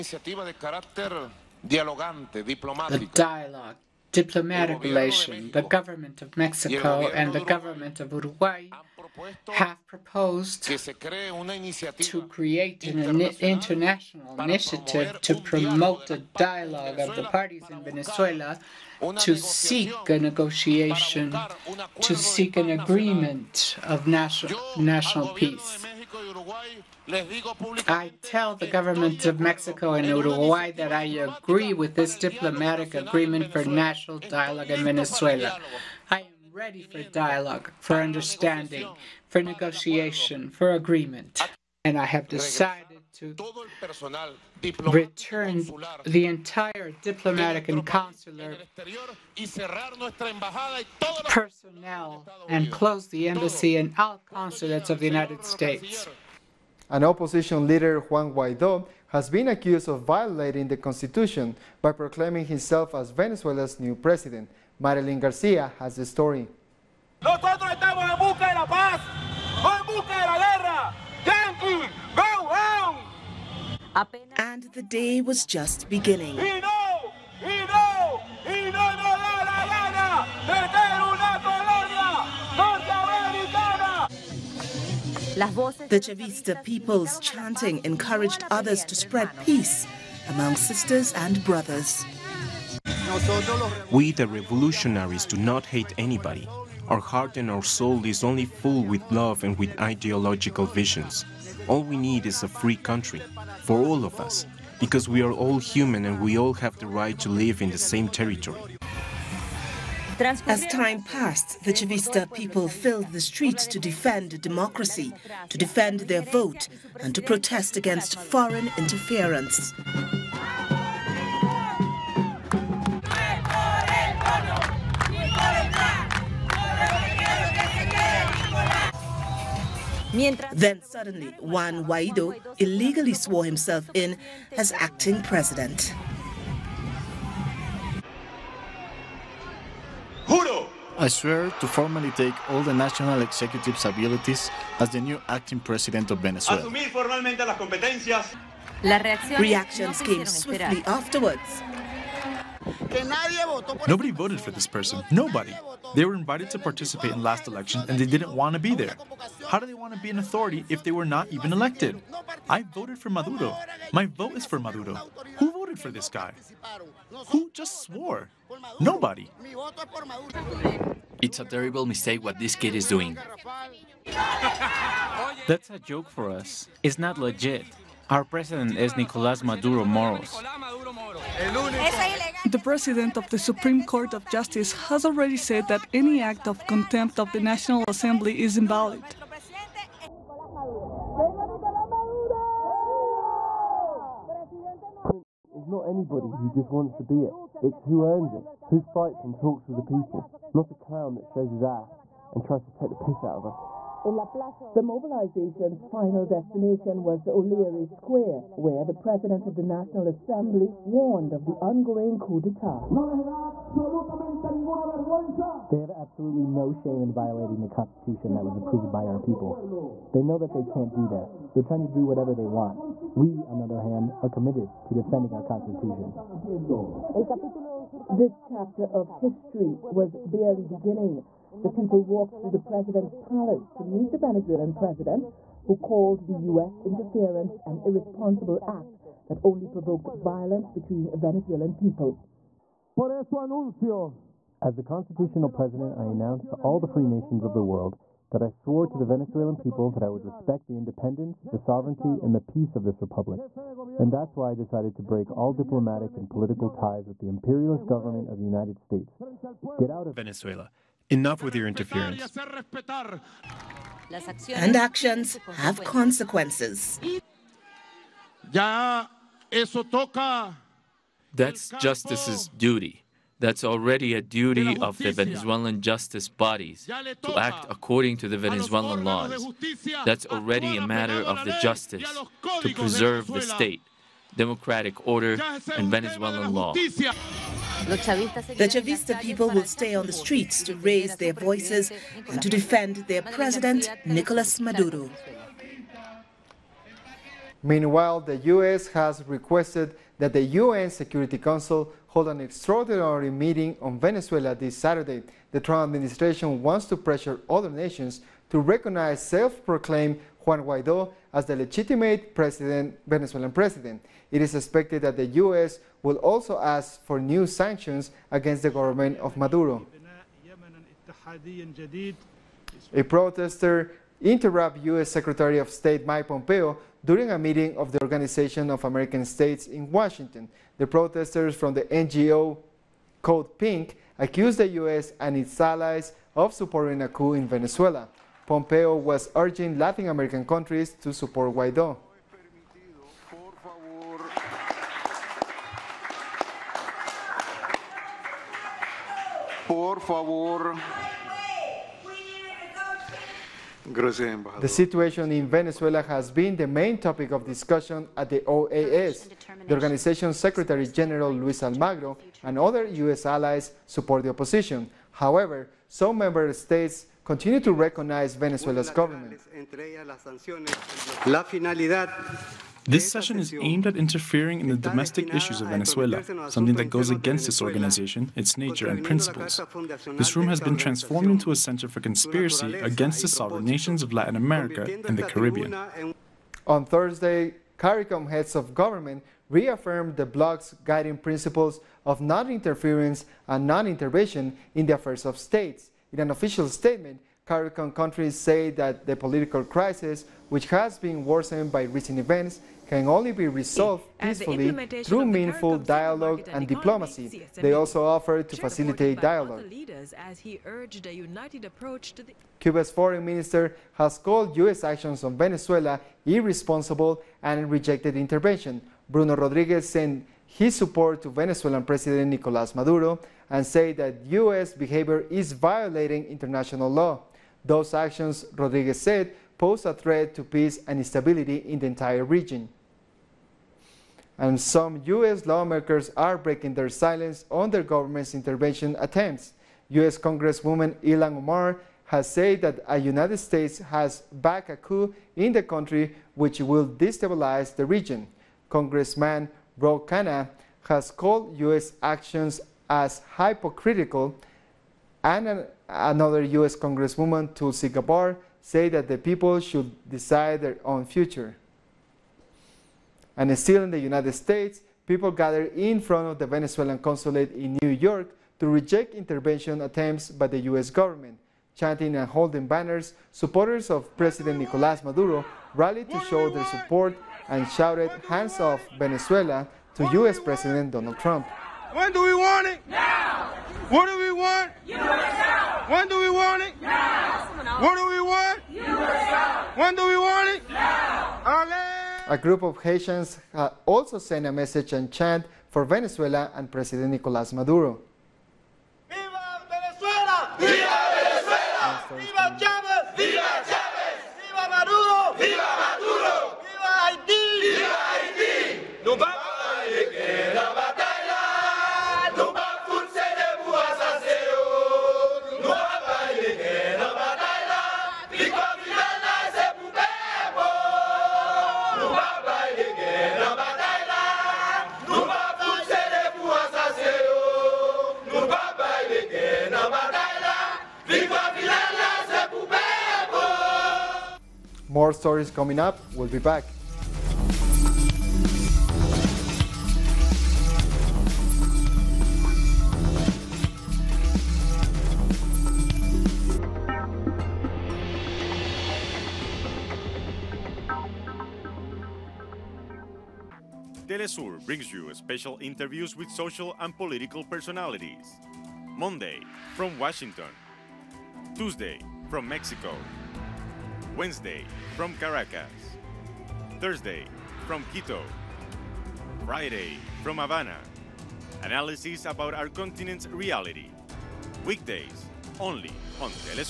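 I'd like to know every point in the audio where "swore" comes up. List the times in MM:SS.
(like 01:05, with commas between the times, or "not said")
02:13, 02:47, 04:08.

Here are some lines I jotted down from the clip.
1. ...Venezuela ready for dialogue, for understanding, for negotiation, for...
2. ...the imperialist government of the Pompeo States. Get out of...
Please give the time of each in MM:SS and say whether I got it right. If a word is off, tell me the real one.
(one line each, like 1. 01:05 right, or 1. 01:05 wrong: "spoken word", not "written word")
1. 00:34 right
2. 04:17 wrong: "United", not "Pompeo".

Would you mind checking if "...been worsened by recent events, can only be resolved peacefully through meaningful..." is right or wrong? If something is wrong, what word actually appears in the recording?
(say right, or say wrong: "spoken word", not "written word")
right.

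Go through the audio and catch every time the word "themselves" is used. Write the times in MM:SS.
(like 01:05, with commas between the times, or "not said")
not said.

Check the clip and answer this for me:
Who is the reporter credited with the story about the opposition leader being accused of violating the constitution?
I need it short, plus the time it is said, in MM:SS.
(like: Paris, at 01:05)
Marilyn Garcia, at 01:04.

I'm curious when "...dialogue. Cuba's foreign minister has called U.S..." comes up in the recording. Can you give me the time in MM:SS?
06:49.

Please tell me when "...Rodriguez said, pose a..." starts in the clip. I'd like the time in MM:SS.
07:08.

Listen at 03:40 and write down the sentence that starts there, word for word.
They know that they can't do that.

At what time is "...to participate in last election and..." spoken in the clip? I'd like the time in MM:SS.
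02:36.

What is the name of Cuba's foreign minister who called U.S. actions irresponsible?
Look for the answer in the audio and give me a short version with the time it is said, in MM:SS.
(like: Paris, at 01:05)
Bruno Rodriguez, at 06:59.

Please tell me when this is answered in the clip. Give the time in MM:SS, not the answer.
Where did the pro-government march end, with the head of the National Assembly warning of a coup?
03:27.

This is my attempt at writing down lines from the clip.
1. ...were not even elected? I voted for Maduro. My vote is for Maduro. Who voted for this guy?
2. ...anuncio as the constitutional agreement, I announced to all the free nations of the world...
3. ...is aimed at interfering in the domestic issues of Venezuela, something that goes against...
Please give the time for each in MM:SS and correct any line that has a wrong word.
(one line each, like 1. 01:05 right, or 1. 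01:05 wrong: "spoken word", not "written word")
1. 02:40 right
2. 04:03 wrong: "president", not "agreement"
3. 06:13 right.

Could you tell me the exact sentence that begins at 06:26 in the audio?
On Thursday, CARICOM heads of government reaffirmed the bloc's guiding principles of non-interference and non-intervention in the affairs of states.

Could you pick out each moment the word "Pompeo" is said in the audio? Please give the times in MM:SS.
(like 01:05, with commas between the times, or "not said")
05:26, 05:38.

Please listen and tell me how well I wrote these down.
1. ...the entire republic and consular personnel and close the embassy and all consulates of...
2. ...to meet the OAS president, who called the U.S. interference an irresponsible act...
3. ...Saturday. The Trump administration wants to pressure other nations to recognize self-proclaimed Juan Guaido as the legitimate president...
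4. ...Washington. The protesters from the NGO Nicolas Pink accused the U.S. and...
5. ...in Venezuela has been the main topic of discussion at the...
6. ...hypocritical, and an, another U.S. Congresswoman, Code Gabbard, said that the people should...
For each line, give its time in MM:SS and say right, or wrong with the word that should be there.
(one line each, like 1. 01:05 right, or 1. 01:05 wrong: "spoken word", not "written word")
1. 00:46 wrong: "diplomatic", not "republic"
2. 03:53 wrong: "Venezuelan", not "OAS"
3. 05:04 right
4. 05:29 wrong: "Code", not "Nicolas"
5. 05:55 right
6. 07:33 wrong: "Tulsi", not "Code".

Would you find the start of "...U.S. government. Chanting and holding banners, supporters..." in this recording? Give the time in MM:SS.
07:50.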